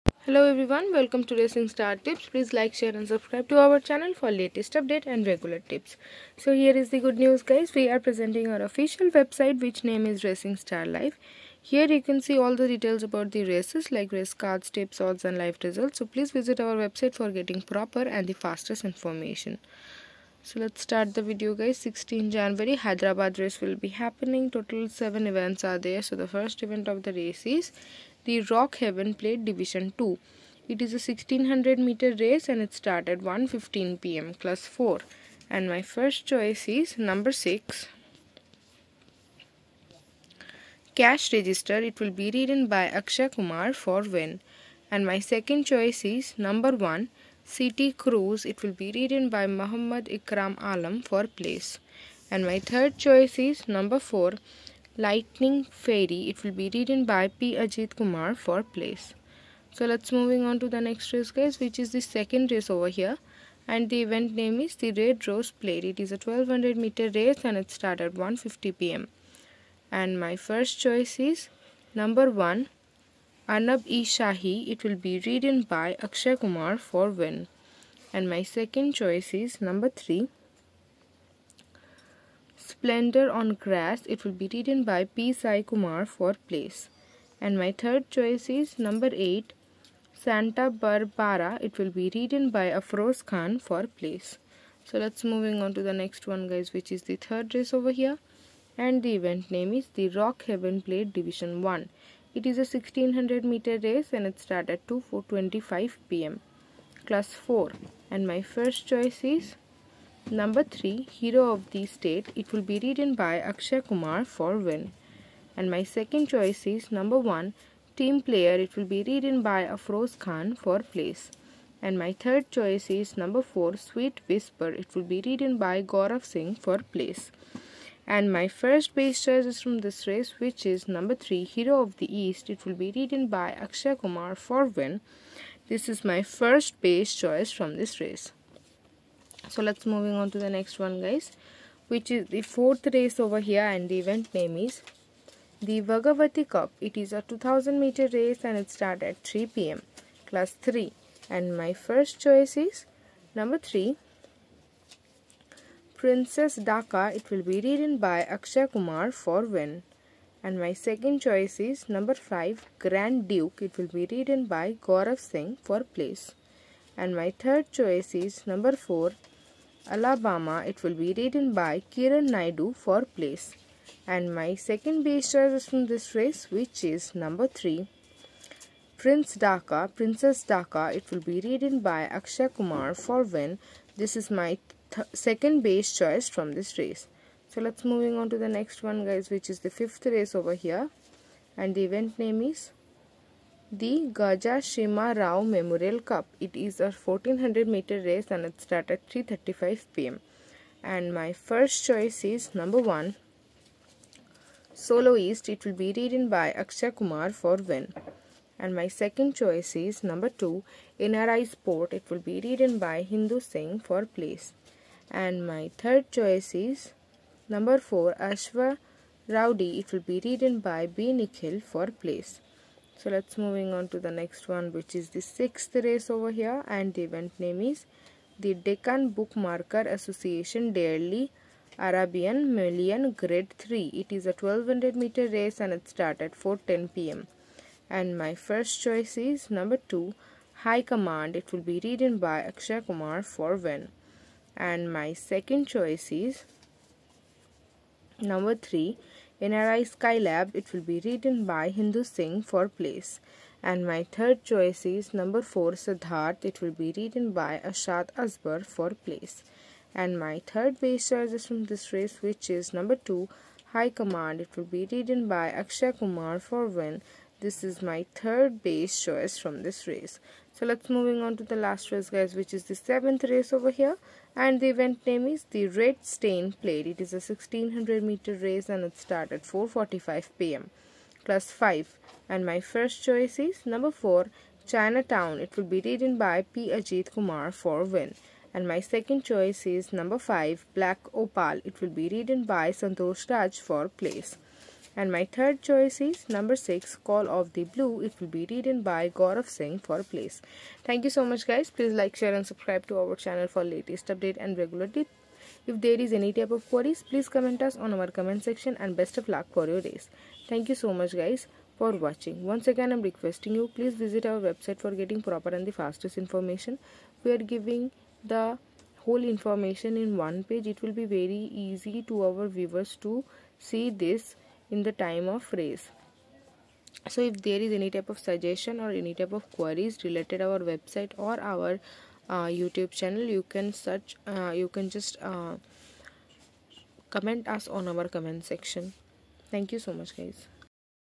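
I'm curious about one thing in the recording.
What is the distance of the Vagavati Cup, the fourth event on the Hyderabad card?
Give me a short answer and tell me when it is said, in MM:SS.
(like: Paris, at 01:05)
2000 meters, at 02:27.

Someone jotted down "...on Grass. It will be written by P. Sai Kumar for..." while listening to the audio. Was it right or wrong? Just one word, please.
right.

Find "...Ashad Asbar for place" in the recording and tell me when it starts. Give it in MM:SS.
04:17.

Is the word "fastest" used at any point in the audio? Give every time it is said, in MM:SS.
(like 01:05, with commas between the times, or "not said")
00:18, 05:15.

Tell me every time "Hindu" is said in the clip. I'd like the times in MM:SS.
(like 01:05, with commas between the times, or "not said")
03:33, 04:11.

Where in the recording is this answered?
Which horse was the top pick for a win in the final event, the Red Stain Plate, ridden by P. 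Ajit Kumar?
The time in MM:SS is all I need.
04:44.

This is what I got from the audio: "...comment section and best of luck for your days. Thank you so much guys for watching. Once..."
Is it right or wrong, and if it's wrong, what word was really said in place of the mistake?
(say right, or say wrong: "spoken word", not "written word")
right.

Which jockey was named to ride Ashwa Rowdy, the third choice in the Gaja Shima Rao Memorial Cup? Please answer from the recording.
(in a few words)
B. Nikhil.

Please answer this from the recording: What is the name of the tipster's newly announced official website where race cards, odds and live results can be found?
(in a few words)
Racing Star Live.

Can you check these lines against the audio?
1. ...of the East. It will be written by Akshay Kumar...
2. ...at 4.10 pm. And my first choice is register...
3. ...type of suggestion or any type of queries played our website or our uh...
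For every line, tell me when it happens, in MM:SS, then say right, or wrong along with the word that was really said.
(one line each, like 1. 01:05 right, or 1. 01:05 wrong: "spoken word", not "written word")
1. 02:11 right
2. 03:56 wrong: "number", not "register"
3. 05:27 wrong: "related", not "played".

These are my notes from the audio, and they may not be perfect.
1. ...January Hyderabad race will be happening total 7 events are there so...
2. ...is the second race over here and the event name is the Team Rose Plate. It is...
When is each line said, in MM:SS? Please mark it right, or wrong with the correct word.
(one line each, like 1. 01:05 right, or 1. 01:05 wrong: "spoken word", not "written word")
1. 00:22 right
2. 01:01 wrong: "Red", not "Team".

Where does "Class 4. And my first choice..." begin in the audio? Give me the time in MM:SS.
01:47.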